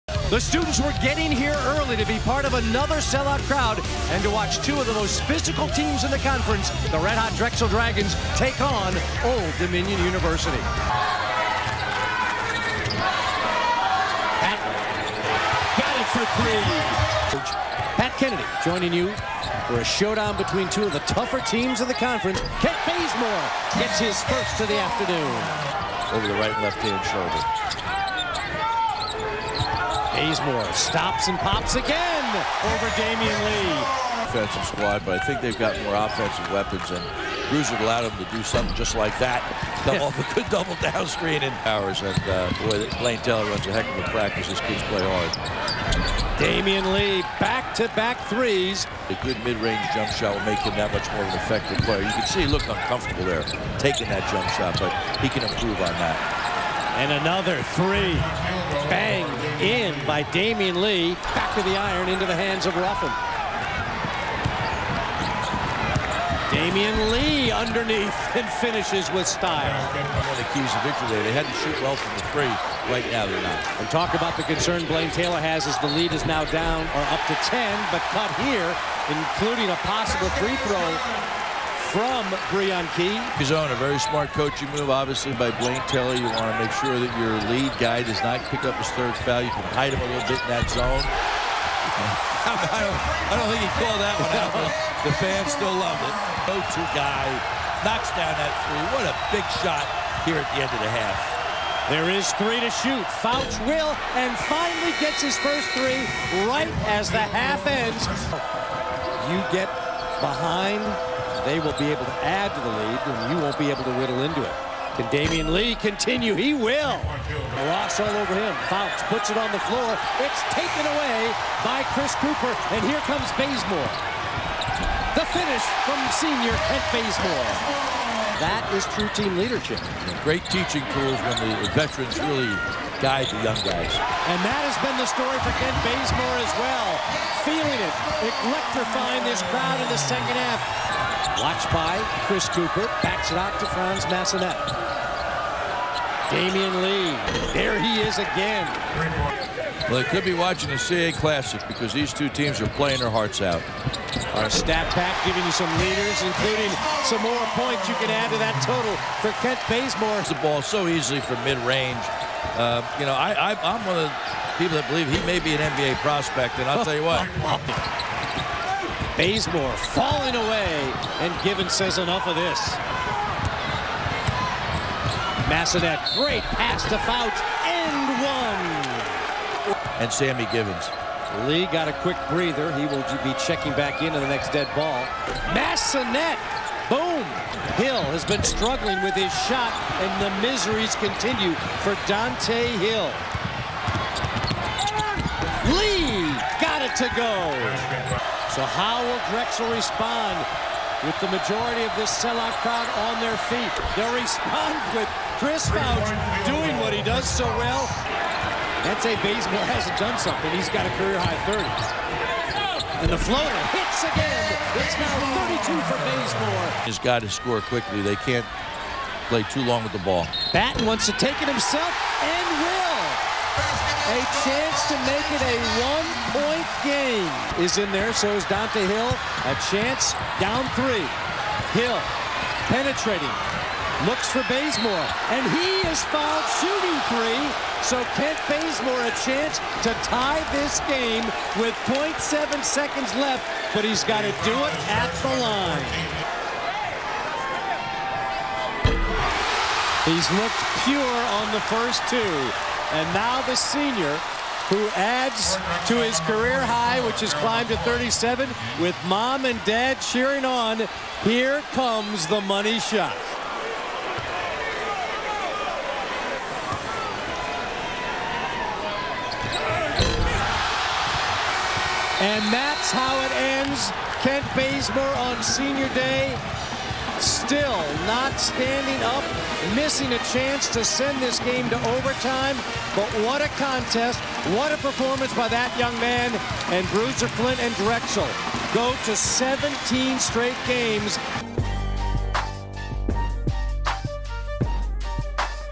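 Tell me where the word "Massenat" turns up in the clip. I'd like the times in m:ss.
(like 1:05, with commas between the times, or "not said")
2:24, 2:55, 3:05.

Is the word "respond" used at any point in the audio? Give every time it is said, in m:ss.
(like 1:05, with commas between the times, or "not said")
3:19, 3:24.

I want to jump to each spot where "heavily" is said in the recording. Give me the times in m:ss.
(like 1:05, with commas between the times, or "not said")
not said.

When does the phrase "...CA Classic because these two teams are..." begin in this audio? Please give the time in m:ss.
2:30.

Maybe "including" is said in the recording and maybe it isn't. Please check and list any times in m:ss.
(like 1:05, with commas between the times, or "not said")
1:19, 2:36.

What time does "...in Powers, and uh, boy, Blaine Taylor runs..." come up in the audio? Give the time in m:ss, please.
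0:41.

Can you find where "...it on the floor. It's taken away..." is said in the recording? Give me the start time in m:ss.
1:59.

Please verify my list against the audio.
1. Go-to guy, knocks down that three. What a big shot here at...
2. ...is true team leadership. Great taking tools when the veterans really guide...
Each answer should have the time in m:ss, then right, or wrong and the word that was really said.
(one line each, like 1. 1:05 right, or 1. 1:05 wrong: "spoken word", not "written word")
1. 1:36 right
2. 2:08 wrong: "teaching", not "taking".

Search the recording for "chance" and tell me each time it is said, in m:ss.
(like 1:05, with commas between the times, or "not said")
3:44, 3:49, 3:59, 4:40.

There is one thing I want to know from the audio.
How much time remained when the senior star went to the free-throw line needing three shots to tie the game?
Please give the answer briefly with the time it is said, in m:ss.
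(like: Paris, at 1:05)
0.7 seconds, at 4:01.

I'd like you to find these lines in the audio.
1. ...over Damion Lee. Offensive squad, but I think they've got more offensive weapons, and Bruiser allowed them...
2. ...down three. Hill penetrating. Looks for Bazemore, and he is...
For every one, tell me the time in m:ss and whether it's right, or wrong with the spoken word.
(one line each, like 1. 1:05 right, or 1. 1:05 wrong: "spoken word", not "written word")
1. 0:32 right
2. 3:50 right.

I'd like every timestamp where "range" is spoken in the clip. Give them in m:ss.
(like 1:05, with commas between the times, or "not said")
0:49, 2:41.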